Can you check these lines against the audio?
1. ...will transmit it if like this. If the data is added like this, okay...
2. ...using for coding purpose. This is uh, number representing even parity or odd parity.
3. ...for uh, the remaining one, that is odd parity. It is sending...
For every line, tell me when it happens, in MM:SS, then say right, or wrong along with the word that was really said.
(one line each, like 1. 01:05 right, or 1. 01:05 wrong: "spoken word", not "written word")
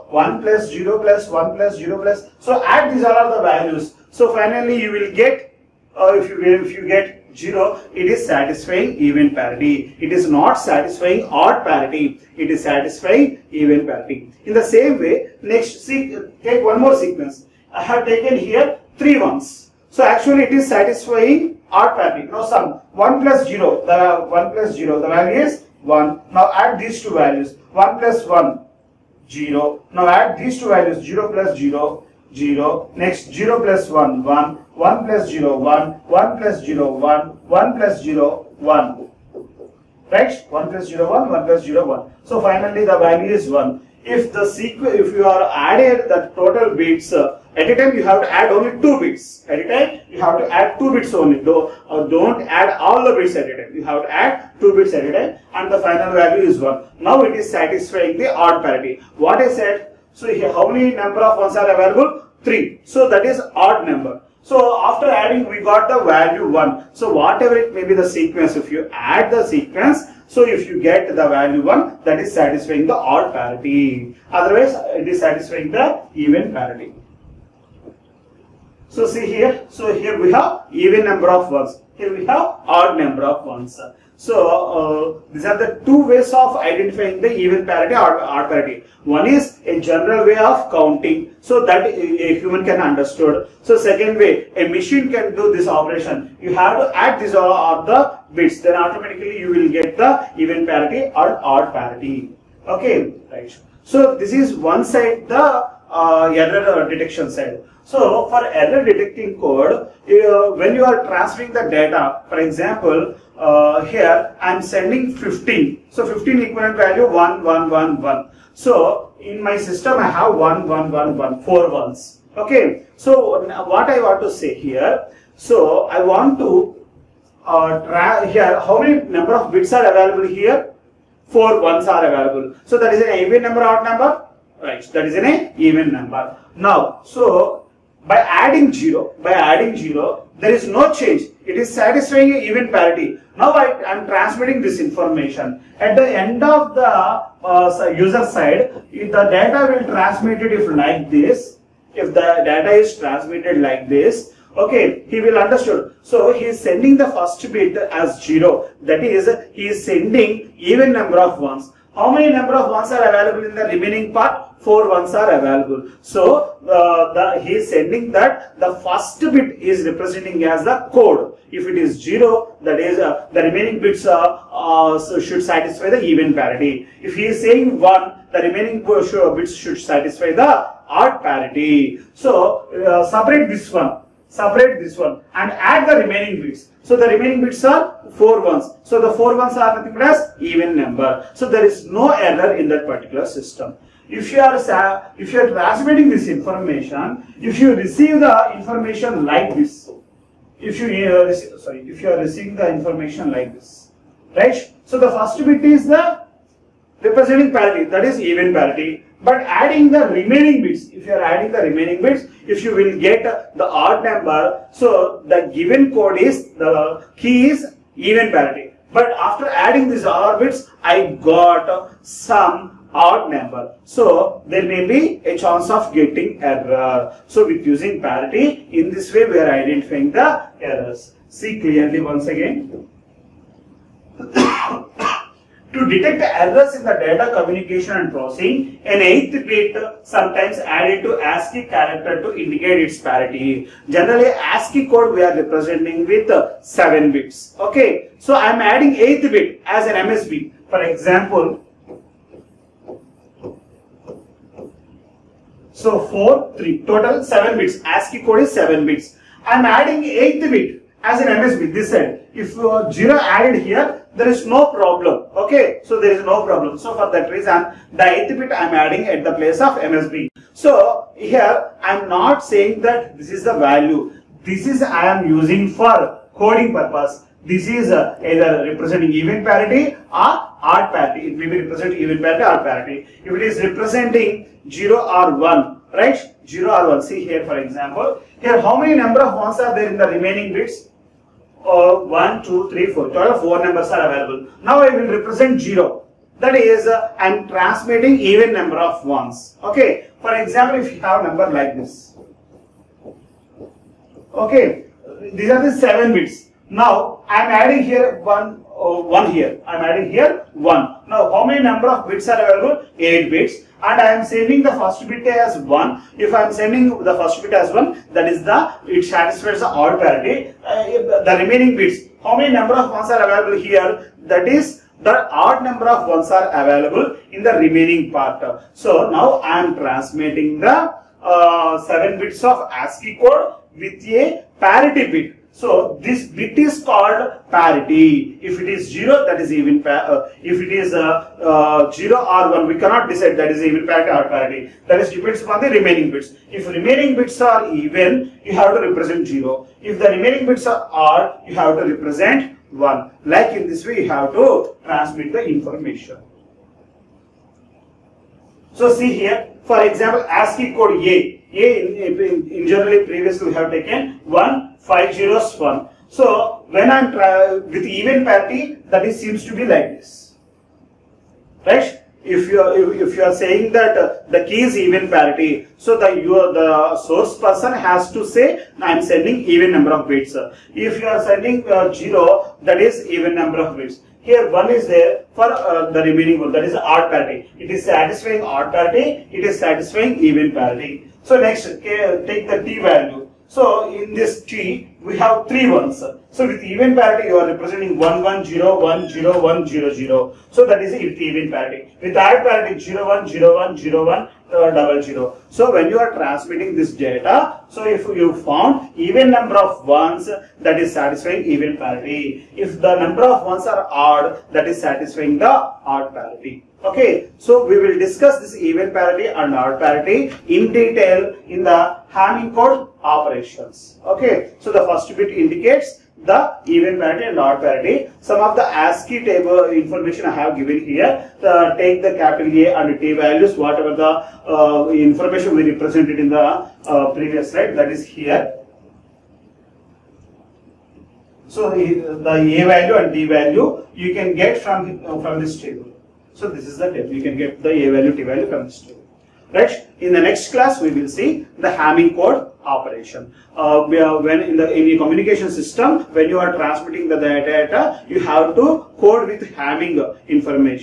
1. 02:29 wrong: "transmitted", not "added"
2. 04:35 wrong: "either", not "number"
3. 06:25 wrong: "satisfying", not "sending".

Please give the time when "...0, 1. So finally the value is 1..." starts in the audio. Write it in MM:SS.
00:41.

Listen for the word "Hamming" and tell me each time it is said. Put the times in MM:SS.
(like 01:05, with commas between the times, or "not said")
07:02, 07:31, 07:39.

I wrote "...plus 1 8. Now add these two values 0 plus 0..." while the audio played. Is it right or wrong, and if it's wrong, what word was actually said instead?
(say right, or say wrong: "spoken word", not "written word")
wrong: "0", not "8".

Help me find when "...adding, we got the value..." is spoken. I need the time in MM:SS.
01:05.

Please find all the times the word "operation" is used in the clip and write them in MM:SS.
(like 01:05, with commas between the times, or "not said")
01:35, 07:03, 07:32.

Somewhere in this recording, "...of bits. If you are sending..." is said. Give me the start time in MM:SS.
06:19.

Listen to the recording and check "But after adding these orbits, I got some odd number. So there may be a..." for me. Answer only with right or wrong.
right.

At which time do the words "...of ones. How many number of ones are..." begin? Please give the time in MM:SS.
02:41.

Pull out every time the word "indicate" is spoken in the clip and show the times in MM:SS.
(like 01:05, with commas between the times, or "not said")
04:02, 07:05.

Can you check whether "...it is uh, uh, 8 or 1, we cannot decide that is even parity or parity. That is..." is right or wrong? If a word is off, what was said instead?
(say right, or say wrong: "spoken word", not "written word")
wrong: "0", not "8".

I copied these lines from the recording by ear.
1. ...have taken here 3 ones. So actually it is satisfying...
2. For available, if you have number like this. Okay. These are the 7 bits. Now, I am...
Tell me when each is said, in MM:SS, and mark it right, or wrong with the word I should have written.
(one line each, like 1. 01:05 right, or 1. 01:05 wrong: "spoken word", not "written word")
1. 00:17 right
2. 05:00 wrong: "example", not "available".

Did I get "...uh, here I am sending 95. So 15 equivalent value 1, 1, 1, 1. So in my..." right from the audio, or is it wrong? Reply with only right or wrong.
wrong.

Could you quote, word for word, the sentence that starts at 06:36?
So with even parity, you are representing 1, 1, 0, 1, 0, 1, 0, 0.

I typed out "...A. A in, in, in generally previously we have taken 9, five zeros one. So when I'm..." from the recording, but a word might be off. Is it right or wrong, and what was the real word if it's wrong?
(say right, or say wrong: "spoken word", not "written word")
wrong: "1", not "9".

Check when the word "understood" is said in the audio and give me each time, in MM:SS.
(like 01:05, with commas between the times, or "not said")
01:32, 02:35.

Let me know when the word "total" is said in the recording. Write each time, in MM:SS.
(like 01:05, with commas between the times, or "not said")
00:46, 04:16, 04:53.